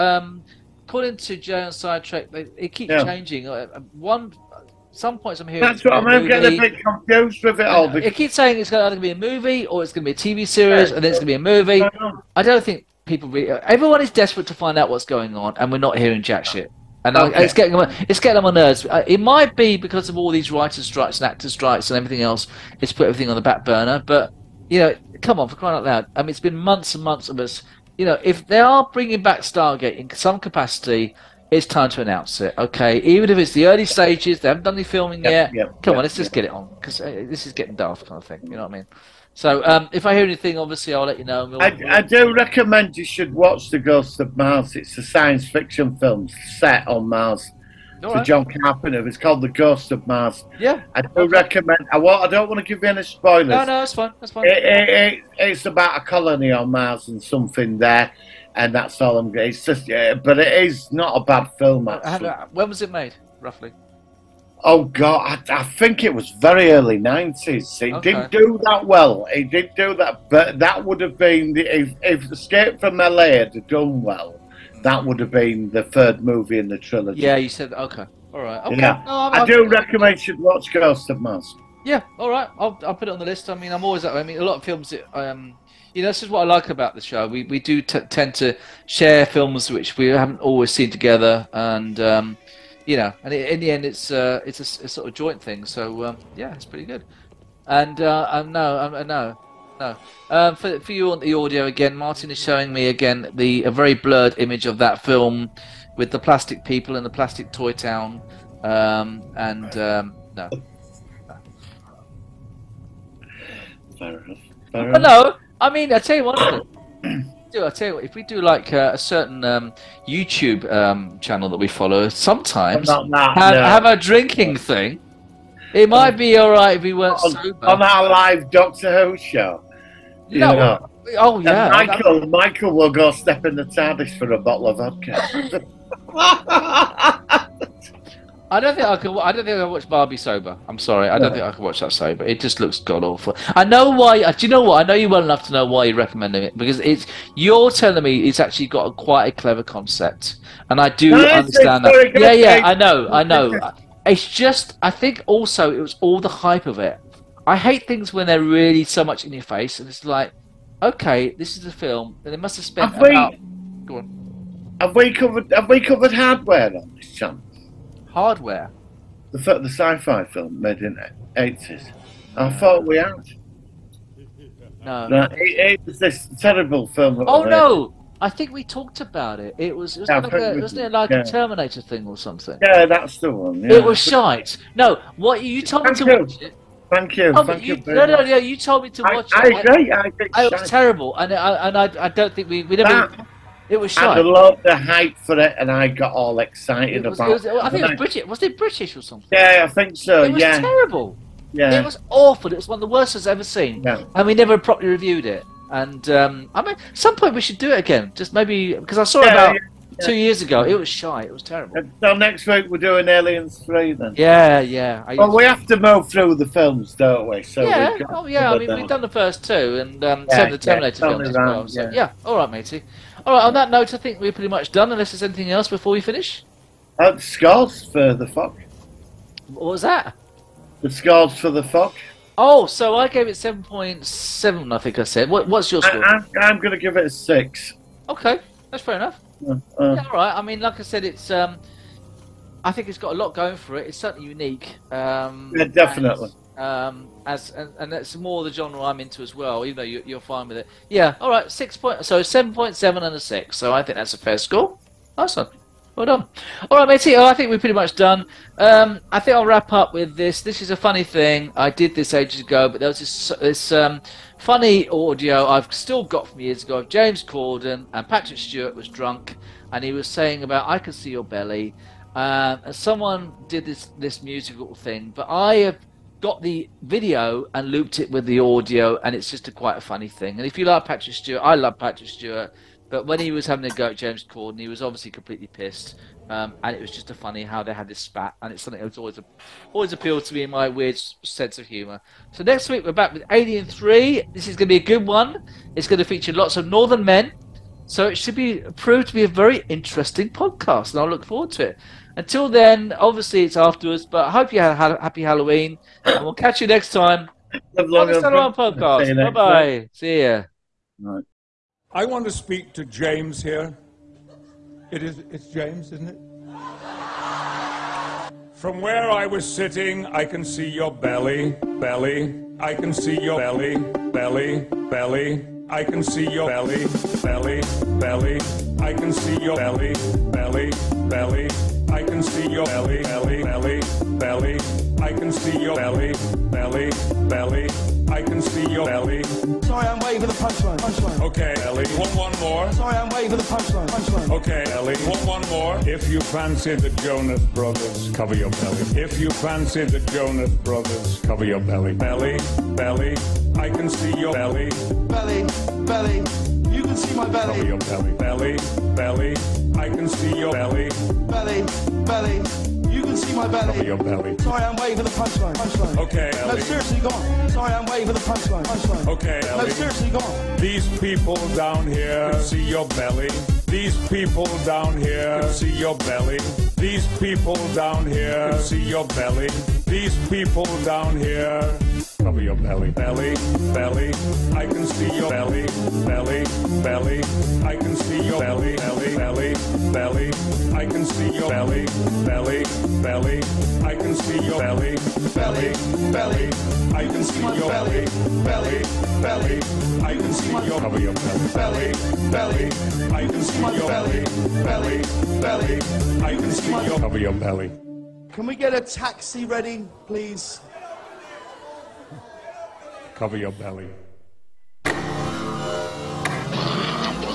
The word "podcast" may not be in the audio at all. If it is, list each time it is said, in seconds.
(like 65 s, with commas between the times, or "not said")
300 s, 308 s.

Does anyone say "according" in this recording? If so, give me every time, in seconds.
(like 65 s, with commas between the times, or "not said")
0 s.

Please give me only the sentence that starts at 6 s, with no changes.
getting a bit confused with it all.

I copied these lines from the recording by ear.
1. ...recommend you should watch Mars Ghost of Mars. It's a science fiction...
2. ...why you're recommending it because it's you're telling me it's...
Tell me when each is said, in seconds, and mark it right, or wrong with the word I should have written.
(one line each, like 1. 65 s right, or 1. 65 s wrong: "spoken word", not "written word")
1. 42 s wrong: "The", not "Mars"
2. 145 s right.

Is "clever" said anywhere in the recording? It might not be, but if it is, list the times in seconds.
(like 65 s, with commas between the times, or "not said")
149 s.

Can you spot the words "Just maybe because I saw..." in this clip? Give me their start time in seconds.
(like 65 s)
208 s.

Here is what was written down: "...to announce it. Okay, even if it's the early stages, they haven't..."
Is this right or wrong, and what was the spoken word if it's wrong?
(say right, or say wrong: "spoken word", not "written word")
right.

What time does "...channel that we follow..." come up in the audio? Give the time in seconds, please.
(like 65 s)
121 s.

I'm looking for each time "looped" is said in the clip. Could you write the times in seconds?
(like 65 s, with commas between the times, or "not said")
277 s.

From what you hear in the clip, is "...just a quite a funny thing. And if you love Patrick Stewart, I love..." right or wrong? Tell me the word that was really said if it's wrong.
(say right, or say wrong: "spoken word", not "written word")
right.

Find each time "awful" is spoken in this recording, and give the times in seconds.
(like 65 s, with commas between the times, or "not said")
143 s, 202 s.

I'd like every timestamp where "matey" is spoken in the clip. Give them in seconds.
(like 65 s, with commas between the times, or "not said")
222 s, 256 s.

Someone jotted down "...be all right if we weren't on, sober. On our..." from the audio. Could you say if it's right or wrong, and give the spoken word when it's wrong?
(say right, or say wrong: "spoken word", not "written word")
right.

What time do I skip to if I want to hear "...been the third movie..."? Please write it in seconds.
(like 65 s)
75 s.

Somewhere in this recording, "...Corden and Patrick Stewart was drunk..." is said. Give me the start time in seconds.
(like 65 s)
267 s.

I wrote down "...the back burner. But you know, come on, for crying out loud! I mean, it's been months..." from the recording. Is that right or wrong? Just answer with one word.
right.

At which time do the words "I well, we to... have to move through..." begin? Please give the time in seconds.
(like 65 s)
215 s.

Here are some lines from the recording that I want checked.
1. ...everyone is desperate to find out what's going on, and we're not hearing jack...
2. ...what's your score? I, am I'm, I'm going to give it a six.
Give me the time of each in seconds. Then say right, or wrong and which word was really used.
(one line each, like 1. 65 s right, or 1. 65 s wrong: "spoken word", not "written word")
1. 13 s right
2. 235 s right.